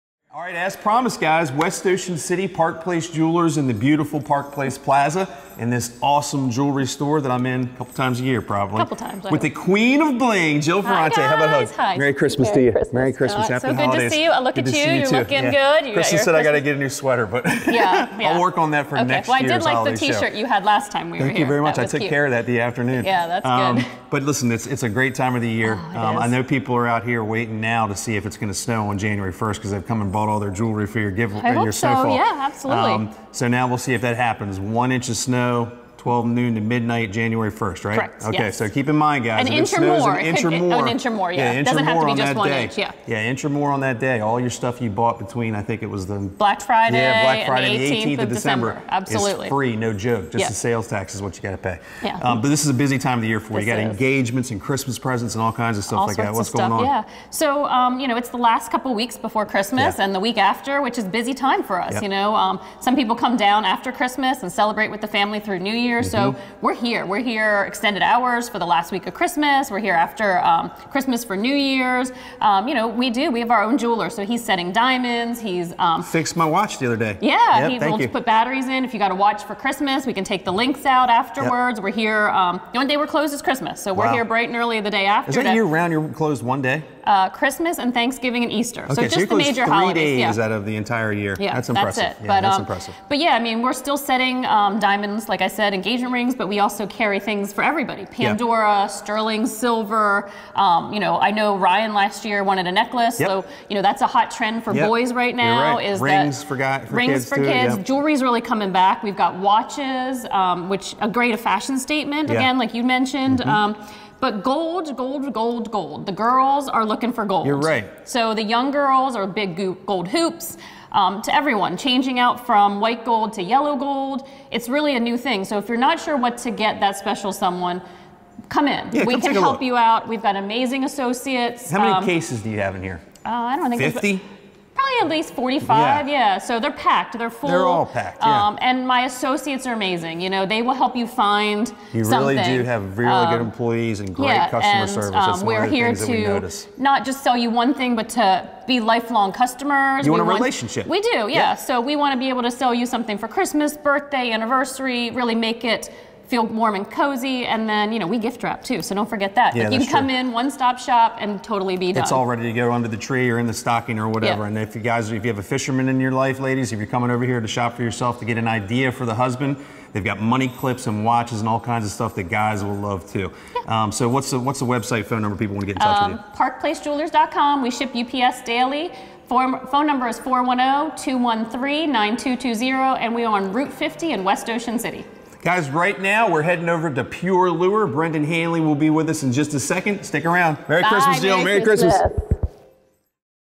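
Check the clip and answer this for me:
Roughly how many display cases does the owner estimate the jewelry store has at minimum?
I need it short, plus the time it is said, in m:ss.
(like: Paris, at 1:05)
45, at 2:15.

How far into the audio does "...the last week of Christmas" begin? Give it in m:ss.
1:08.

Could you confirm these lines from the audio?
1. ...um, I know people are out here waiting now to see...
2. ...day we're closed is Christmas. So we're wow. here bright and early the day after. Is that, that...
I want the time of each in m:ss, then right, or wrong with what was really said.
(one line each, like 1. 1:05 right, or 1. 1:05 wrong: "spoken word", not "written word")
1. 0:25 right
2. 1:22 right.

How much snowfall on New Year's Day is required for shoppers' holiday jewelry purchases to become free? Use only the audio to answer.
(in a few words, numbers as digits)
1 inch or more.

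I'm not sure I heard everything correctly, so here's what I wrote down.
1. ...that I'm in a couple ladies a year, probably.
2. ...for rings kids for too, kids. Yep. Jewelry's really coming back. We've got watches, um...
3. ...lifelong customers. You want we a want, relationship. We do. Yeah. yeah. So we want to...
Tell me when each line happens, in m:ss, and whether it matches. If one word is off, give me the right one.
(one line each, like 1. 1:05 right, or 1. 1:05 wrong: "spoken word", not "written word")
1. 0:07 wrong: "times", not "ladies"
2. 1:46 right
3. 2:28 right.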